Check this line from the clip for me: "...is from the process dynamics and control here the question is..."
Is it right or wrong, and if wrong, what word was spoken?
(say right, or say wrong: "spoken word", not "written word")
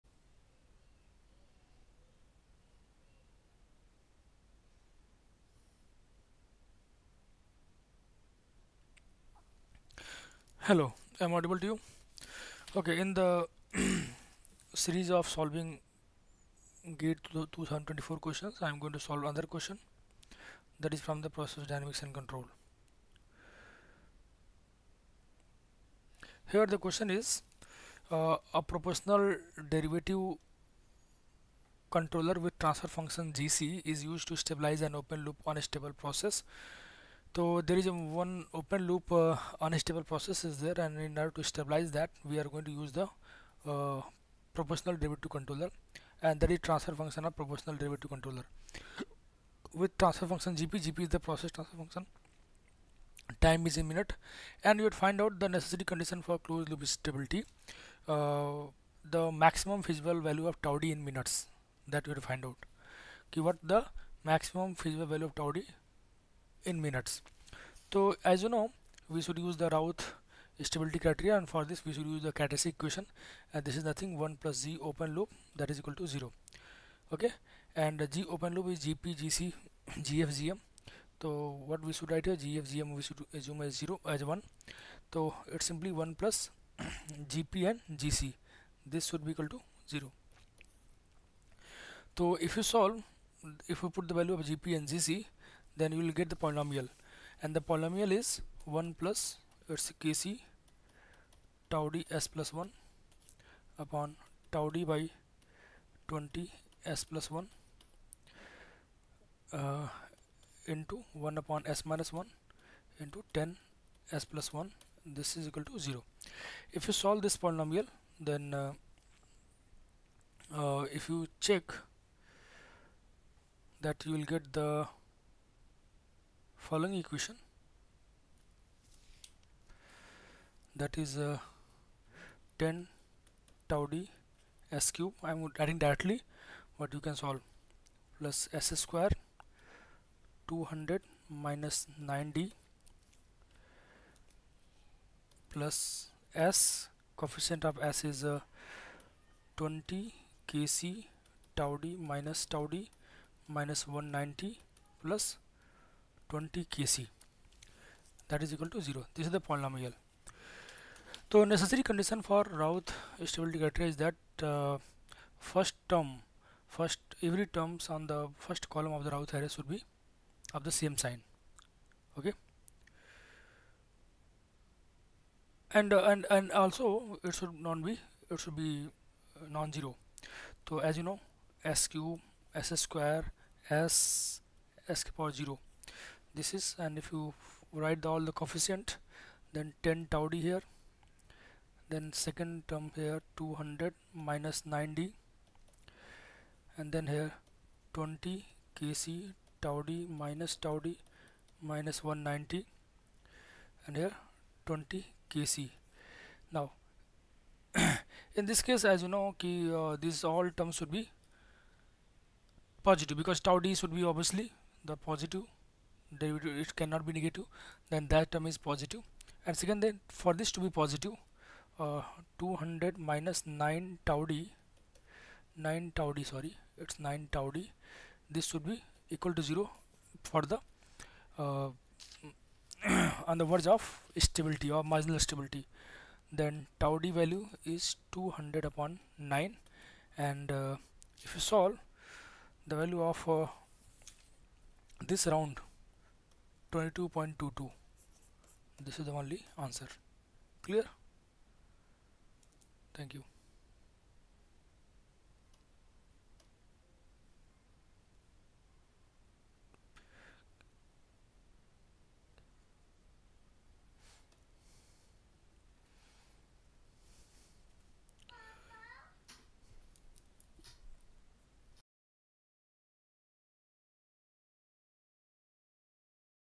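right.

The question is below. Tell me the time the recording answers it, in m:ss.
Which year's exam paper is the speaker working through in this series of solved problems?
0:17.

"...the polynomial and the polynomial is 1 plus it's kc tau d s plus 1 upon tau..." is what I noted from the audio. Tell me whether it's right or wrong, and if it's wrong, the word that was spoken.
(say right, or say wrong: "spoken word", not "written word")
right.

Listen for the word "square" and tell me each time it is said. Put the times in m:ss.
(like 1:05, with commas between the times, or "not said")
2:18, 3:02.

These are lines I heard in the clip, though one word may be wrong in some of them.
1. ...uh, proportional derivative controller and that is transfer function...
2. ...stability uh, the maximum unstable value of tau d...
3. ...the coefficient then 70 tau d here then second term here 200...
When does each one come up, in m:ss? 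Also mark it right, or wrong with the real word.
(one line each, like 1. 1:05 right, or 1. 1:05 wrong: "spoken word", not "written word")
1. 0:43 right
2. 0:56 wrong: "feasible", not "unstable"
3. 3:08 wrong: "10", not "70".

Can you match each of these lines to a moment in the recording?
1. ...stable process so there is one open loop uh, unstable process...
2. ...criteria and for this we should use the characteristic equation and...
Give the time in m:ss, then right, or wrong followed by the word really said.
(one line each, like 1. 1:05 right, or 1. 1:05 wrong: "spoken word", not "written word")
1. 0:35 right
2. 1:10 right.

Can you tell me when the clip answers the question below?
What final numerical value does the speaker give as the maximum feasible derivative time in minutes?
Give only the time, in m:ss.
4:06.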